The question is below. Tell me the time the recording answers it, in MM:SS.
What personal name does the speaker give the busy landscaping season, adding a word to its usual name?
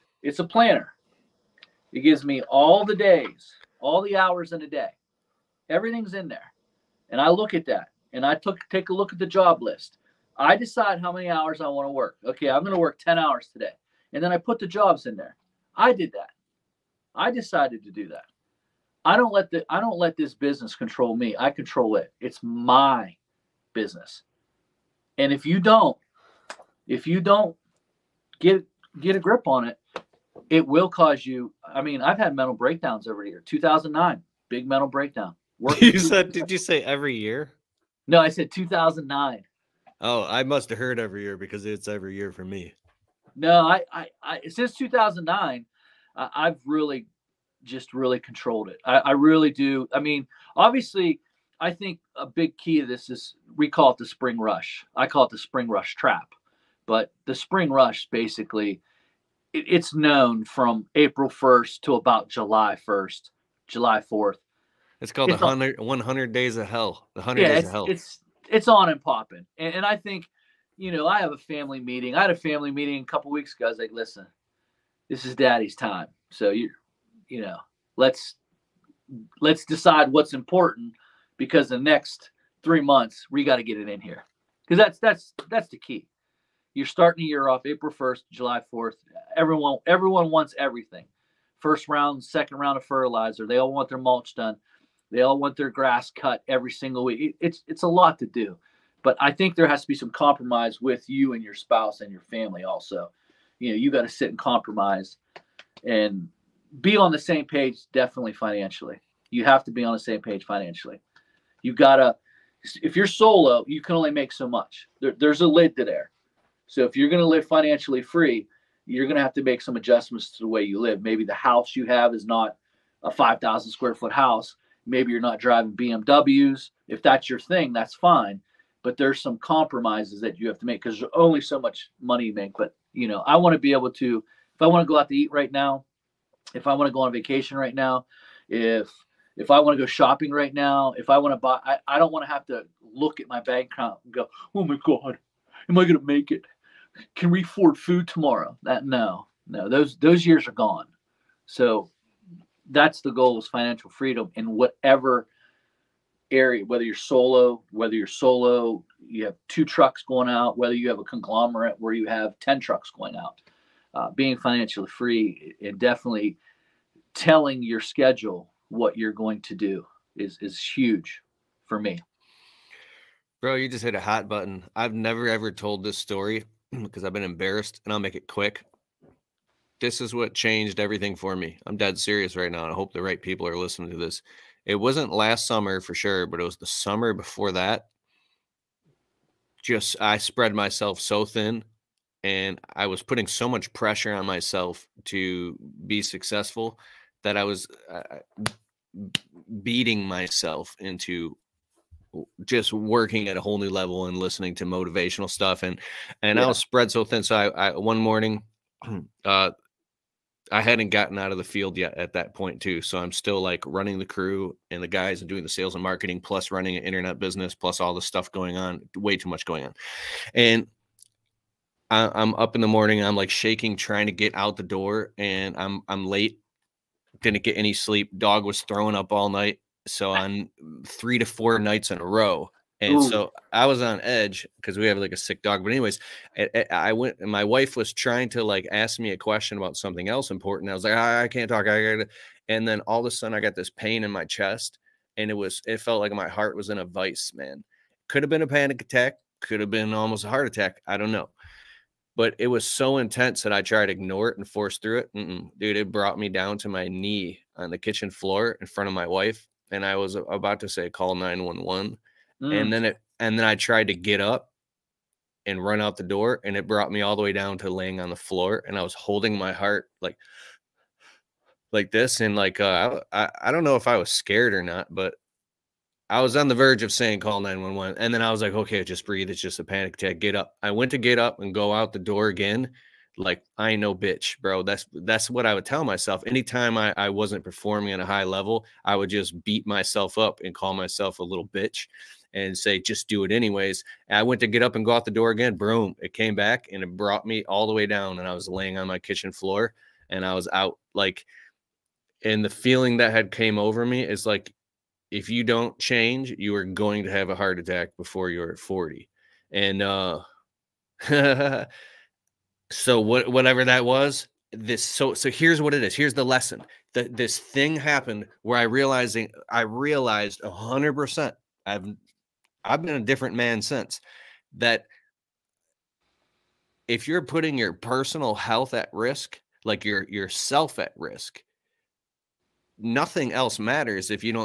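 00:55.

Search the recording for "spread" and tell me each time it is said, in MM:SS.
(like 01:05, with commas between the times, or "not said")
03:10, 03:26.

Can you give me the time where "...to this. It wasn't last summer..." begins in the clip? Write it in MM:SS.
03:03.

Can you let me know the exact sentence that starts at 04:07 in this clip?
Man, could have been a panic attack.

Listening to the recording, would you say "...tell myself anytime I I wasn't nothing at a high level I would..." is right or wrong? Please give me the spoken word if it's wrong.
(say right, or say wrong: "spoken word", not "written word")
wrong: "performing", not "nothing".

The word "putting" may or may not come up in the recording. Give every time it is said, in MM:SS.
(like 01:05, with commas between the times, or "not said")
03:13, 05:27.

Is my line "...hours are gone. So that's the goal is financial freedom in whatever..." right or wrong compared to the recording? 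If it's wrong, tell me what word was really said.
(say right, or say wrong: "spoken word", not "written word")
wrong: "years", not "hours".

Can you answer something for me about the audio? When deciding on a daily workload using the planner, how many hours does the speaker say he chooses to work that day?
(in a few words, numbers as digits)
10 hours.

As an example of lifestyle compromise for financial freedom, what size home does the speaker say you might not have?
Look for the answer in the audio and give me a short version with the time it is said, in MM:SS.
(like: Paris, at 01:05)
5,000 square foot, at 02:03.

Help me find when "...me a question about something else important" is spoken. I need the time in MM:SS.
03:58.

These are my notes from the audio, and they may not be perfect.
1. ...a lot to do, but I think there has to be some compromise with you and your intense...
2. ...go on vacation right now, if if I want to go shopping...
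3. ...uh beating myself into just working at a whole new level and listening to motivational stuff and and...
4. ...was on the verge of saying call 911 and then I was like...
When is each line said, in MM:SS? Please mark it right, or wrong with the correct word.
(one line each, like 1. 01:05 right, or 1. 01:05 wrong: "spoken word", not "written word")
1. 01:37 wrong: "spouse", not "intense"
2. 02:16 right
3. 03:18 right
4. 04:36 right.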